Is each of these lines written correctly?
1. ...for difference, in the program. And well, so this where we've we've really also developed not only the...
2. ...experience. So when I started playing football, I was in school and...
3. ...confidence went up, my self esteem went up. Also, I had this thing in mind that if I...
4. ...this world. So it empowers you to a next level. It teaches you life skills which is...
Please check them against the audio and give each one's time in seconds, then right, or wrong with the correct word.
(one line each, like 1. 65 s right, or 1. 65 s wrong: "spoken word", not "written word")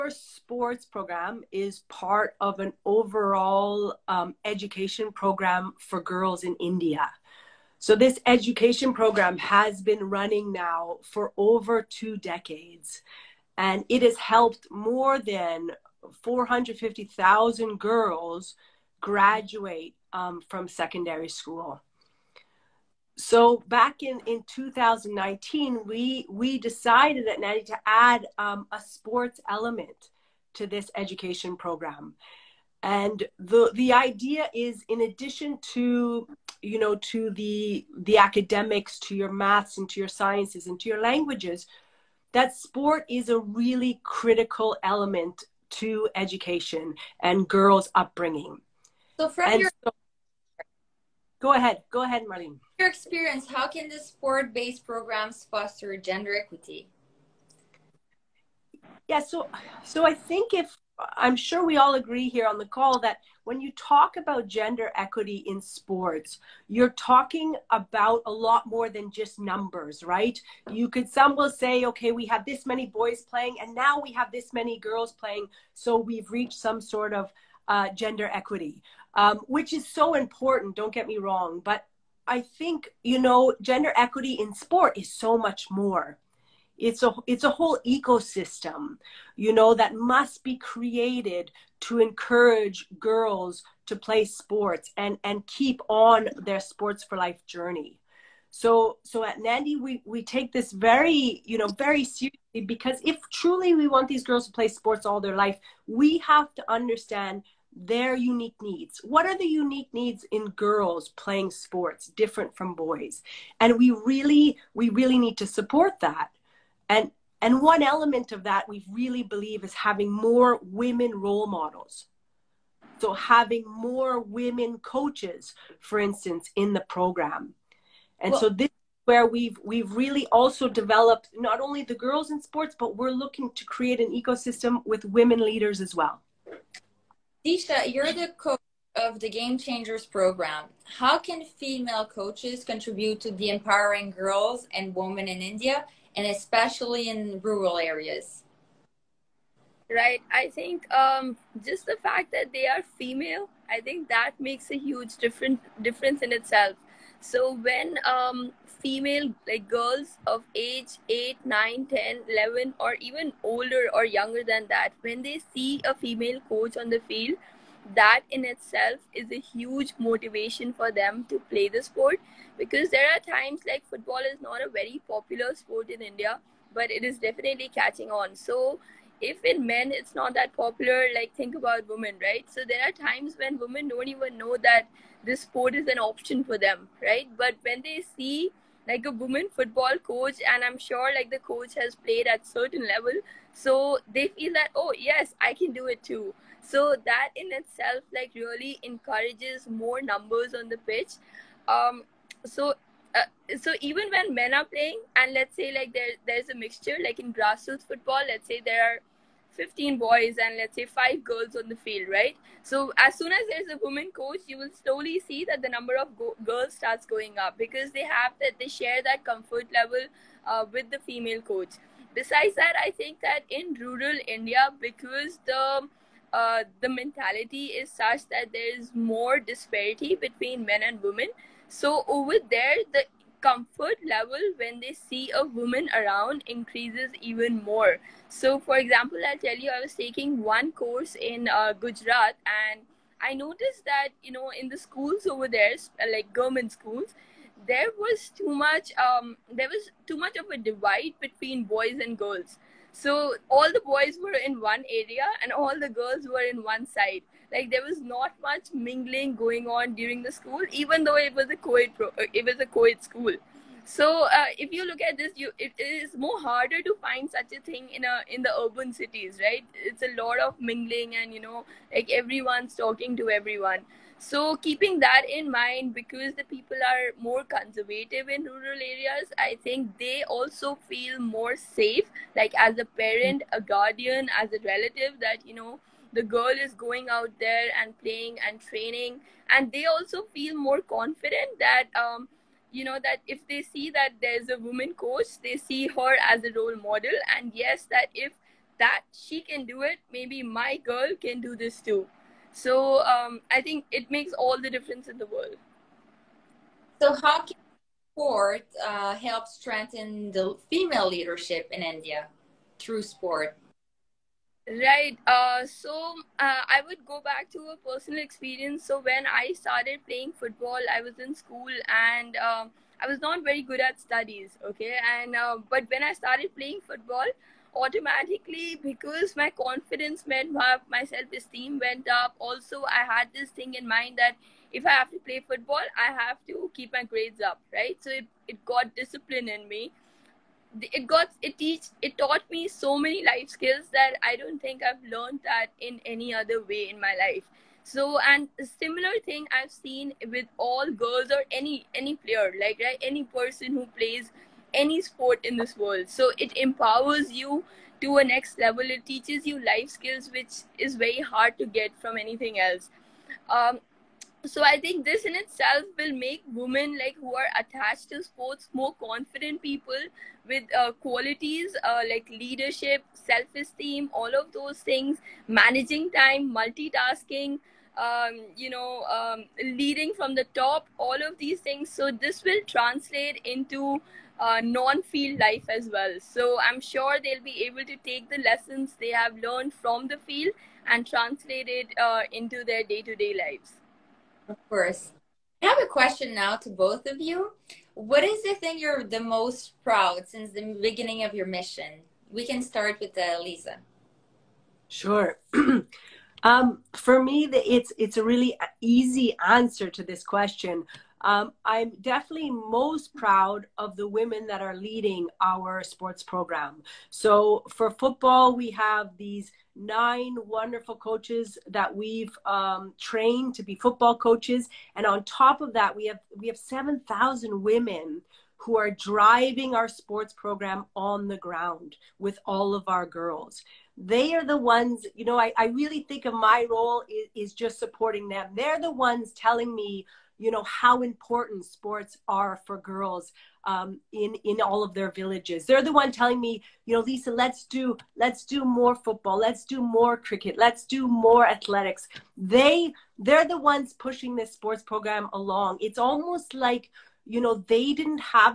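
1. 125 s wrong: "instance", not "difference"
2. 318 s right
3. 329 s right
4. 355 s right.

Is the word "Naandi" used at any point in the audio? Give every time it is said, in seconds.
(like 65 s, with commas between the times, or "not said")
27 s, 99 s.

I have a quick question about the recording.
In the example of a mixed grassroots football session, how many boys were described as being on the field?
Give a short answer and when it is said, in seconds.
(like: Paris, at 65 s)
15, at 209 s.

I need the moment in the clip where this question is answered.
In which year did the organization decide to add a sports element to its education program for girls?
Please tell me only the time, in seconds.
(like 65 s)
24 s.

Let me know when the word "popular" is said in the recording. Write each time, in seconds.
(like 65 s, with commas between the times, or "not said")
175 s, 180 s.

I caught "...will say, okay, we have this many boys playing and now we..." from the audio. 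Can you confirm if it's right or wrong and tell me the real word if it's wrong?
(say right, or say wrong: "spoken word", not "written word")
right.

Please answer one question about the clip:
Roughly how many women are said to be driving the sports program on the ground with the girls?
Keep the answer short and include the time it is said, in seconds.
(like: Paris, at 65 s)
7,000, at 426 s.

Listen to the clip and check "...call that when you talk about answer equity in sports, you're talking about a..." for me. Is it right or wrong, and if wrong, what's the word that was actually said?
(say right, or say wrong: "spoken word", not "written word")
wrong: "gender", not "answer".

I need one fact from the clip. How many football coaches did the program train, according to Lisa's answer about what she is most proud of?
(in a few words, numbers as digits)
9.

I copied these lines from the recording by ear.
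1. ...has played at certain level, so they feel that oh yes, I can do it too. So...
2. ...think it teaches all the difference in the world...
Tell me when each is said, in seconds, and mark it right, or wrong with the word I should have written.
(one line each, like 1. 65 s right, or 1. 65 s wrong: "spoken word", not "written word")
1. 191 s right
2. 303 s wrong: "makes", not "teaches".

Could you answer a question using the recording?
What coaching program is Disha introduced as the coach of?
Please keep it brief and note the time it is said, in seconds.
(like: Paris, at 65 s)
Game Changers, at 139 s.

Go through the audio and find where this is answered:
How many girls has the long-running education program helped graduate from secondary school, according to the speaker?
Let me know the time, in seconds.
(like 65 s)
16 s.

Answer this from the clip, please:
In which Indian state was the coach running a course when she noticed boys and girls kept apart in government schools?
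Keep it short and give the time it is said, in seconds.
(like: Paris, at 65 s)
Gujarat, at 241 s.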